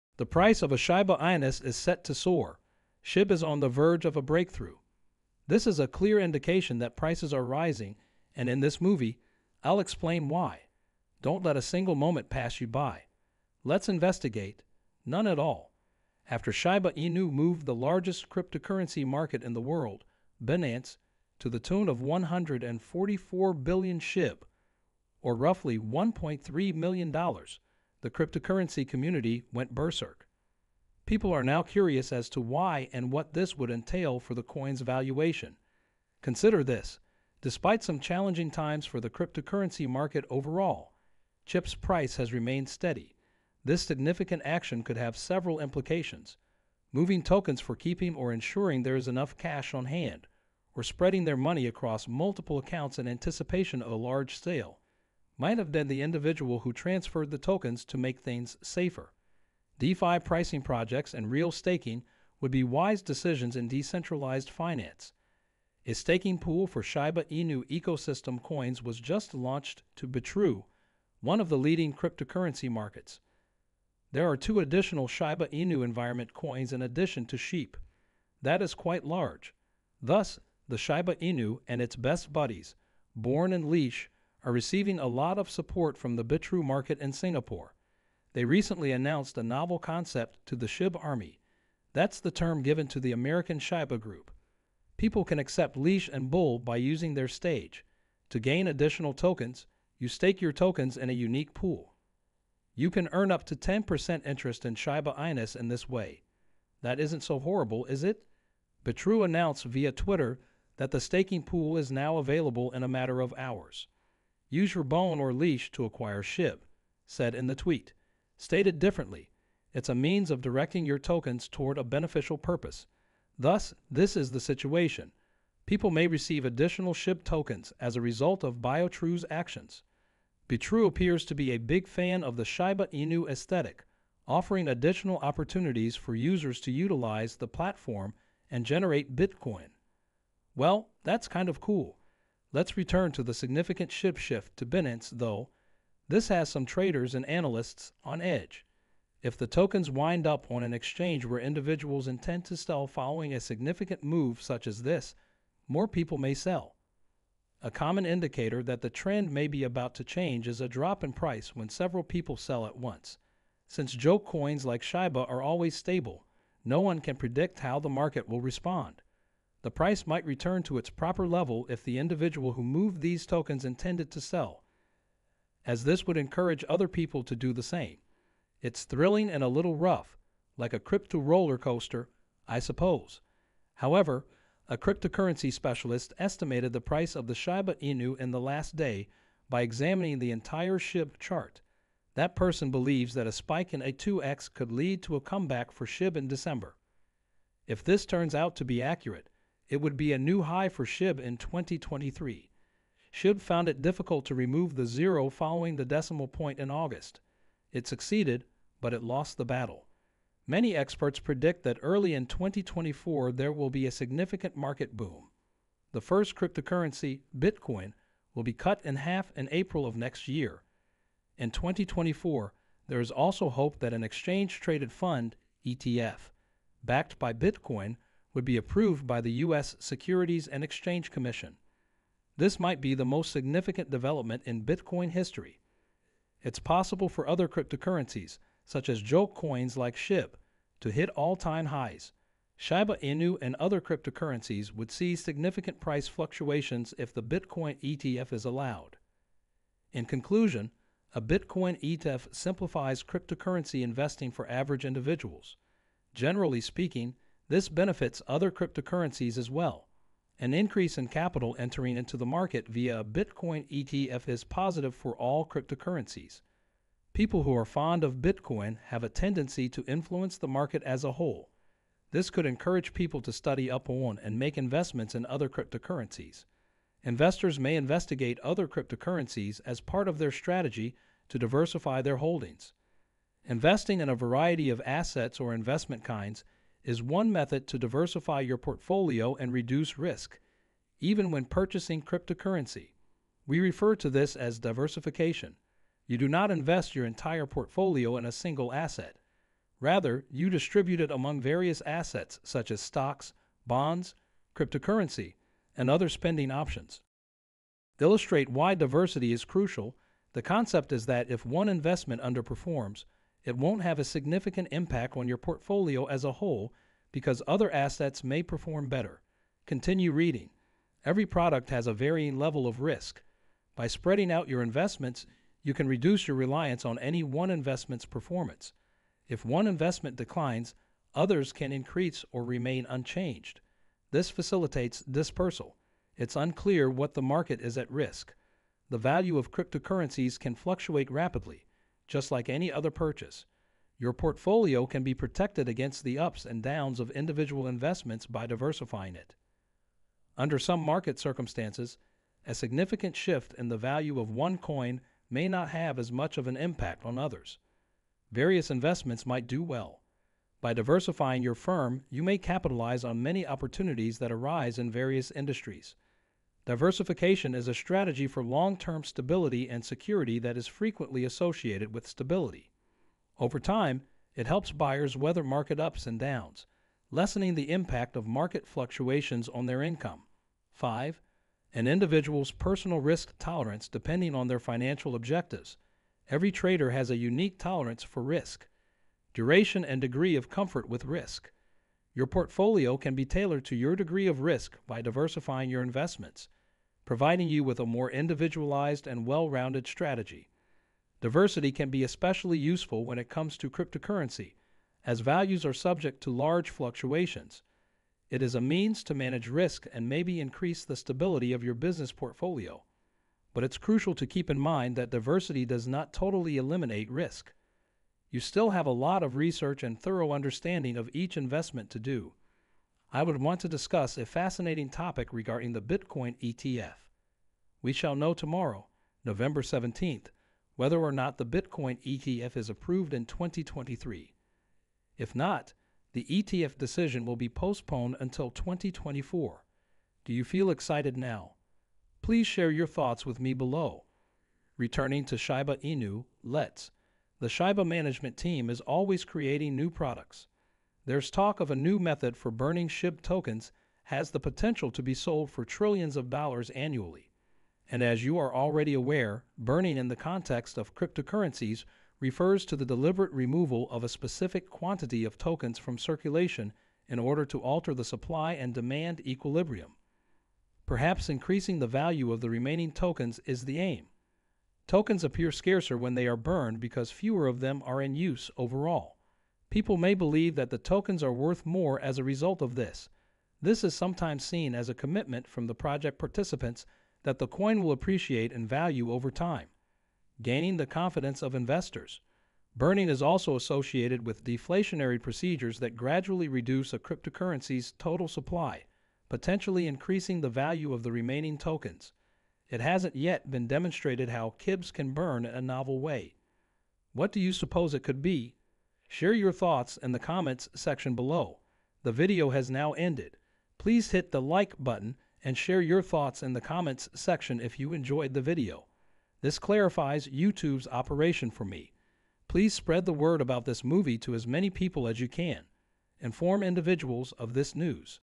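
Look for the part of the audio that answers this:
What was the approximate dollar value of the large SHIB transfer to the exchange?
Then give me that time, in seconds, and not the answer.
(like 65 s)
25 s.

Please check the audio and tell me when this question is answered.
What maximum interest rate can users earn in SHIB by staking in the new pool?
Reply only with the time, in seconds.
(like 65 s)
103 s.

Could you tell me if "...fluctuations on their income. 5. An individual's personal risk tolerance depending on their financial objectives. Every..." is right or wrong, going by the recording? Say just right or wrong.
right.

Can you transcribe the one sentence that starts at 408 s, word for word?
It is a means to manage risk and maybe increase the stability of your business portfolio.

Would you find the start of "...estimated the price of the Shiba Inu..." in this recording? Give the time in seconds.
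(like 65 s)
186 s.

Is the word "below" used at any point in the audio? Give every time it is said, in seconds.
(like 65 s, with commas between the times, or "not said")
443 s, 511 s.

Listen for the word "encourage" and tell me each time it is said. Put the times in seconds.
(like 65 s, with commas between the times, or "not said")
176 s, 272 s.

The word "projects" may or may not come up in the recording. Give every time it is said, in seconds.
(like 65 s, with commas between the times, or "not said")
60 s, 485 s.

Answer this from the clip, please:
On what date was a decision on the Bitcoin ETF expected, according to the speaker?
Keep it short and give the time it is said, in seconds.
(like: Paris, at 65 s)
November 17th, at 429 s.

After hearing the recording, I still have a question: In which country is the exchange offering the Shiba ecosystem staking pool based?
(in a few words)
Singapore.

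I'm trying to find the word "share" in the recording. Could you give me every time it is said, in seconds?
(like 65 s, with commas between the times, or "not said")
442 s, 509 s, 515 s.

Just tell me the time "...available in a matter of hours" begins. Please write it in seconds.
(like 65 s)
112 s.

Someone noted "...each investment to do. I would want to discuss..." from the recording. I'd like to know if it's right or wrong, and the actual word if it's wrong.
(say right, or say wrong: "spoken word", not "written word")
right.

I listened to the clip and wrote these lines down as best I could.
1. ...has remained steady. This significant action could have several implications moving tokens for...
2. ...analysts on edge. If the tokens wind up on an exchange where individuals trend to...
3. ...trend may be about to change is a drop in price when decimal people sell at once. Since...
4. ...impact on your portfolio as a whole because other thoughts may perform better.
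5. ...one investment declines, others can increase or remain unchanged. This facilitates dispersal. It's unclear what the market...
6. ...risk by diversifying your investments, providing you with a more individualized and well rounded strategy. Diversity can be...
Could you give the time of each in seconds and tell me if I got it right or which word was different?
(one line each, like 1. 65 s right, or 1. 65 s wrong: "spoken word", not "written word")
1. 42 s right
2. 147 s wrong: "intend", not "trend"
3. 158 s wrong: "several", not "decimal"
4. 314 s wrong: "assets", not "thoughts"
5. 329 s right
6. 394 s right.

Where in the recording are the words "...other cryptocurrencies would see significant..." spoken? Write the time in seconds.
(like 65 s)
243 s.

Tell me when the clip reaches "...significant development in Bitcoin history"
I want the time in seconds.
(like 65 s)
233 s.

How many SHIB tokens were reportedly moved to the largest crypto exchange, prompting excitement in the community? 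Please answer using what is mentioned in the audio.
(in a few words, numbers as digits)
144 billion.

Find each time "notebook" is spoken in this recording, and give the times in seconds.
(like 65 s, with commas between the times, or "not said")
not said.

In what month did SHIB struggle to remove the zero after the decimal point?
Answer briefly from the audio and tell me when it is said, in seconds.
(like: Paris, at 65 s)
August, at 206 s.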